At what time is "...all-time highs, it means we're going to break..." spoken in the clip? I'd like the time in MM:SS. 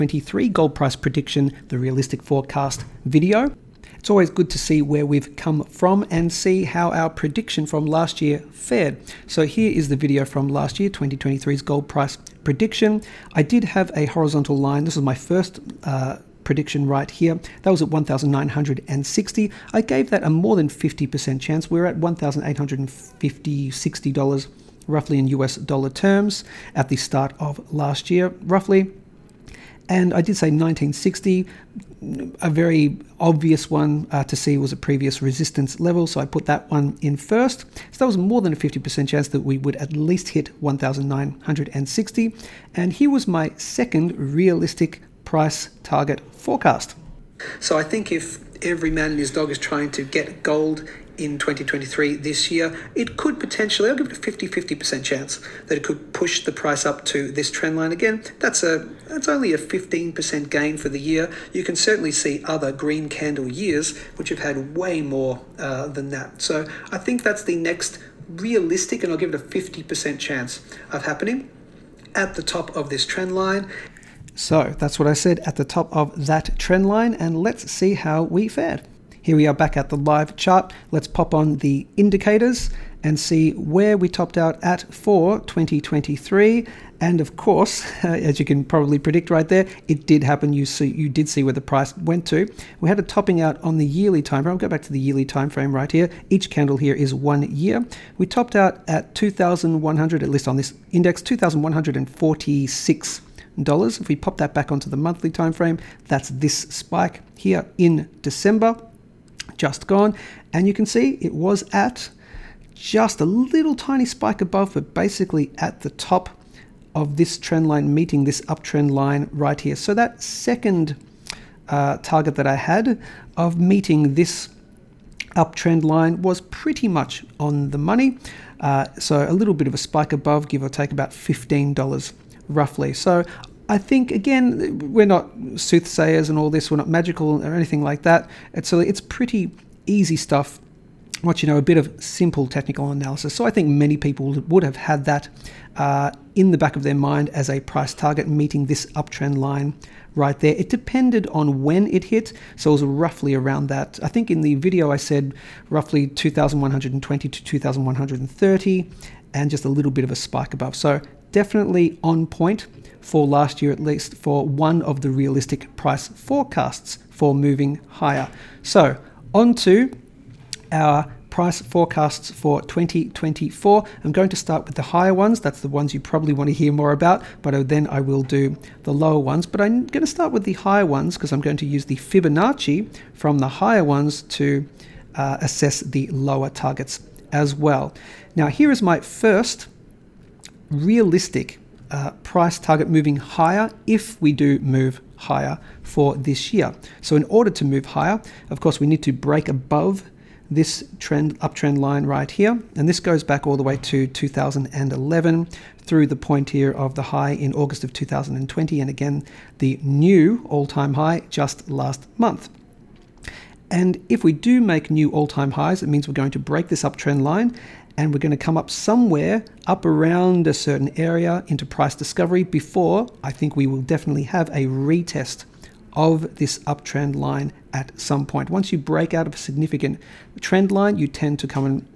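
03:35.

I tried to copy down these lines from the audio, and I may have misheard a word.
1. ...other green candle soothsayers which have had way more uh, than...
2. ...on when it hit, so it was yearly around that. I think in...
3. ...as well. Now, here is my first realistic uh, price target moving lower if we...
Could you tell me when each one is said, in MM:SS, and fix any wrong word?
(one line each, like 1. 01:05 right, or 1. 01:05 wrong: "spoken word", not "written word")
1. 01:02 wrong: "years", not "soothsayers"
2. 02:31 wrong: "roughly", not "yearly"
3. 03:07 wrong: "higher", not "lower".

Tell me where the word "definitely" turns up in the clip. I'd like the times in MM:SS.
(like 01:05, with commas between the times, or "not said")
02:41, 03:43.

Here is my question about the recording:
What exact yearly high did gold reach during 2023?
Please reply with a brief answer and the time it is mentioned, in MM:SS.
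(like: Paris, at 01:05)
$2,146, at 01:41.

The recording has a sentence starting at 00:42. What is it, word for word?
And here was my second realistic price target forecast.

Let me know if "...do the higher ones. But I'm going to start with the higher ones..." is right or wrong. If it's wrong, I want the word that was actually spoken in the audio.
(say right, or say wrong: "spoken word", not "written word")
wrong: "lower", not "higher".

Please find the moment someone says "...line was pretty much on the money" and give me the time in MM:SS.
02:05.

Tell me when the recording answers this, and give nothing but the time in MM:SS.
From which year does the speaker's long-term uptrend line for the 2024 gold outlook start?
03:24.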